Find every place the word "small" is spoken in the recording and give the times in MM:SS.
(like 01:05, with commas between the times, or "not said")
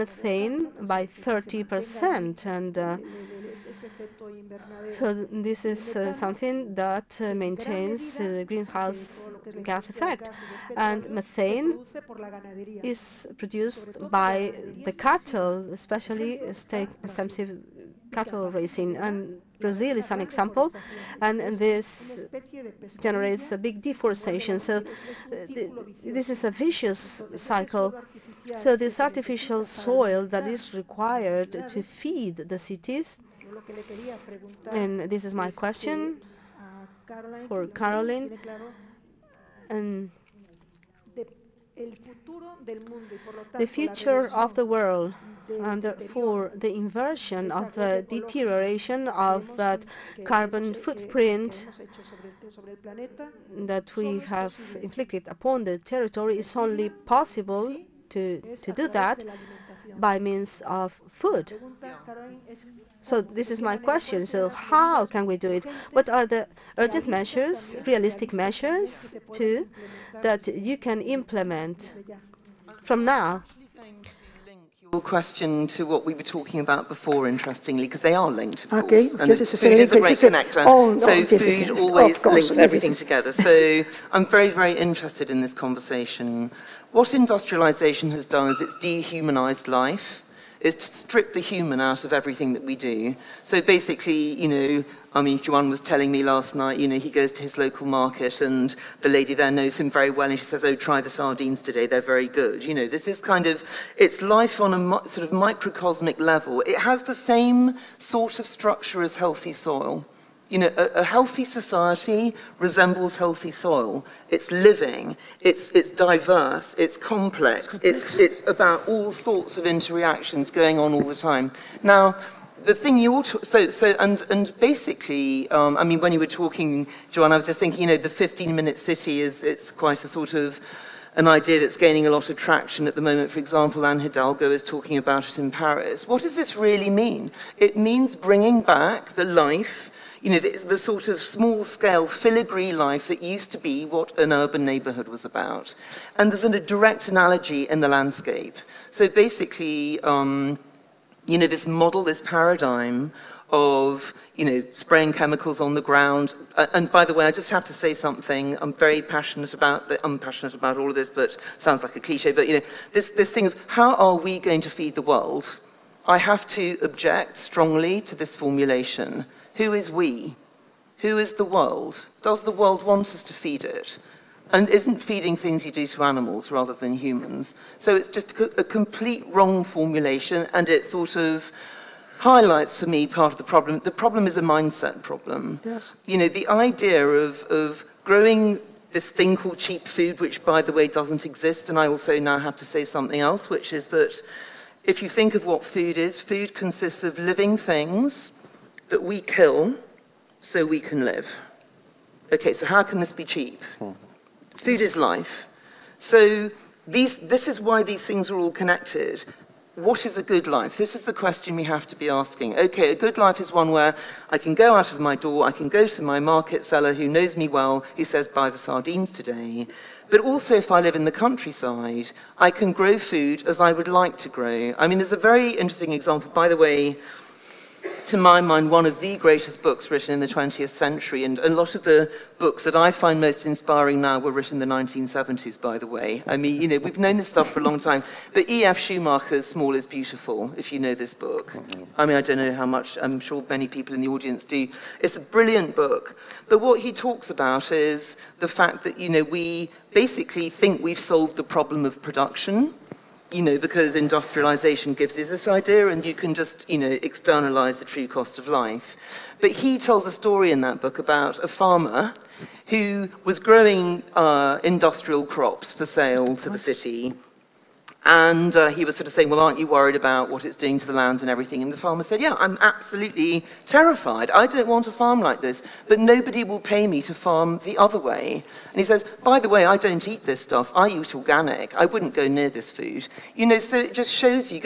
02:21, 03:59.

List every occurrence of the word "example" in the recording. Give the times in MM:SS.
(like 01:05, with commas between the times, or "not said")
00:20, 02:13, 03:45.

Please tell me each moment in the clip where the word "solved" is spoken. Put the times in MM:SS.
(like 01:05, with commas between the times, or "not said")
04:10.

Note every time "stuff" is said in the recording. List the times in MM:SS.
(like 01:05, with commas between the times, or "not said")
03:57, 04:40.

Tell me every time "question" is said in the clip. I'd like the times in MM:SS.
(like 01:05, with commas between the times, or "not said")
00:35, 01:03, 01:15, 03:31.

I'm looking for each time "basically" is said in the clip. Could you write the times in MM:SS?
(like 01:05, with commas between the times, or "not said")
01:33, 02:04, 02:29, 04:09.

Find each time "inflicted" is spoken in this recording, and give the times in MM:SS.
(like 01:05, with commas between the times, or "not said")
00:54.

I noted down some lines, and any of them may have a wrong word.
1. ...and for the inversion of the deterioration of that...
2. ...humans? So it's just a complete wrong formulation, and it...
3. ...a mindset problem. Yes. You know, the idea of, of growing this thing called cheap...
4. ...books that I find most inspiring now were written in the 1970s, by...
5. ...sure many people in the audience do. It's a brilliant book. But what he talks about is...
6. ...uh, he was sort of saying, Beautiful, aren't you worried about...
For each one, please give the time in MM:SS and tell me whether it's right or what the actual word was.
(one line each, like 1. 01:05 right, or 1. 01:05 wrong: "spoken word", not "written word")
1. 00:45 right
2. 02:56 right
3. 03:04 right
4. 03:52 right
5. 04:03 right
6. 04:28 wrong: "Well", not "Beautiful".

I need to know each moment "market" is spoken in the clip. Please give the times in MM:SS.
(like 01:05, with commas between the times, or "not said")
01:37, 03:36.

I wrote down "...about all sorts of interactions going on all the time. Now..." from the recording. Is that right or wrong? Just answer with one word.
right.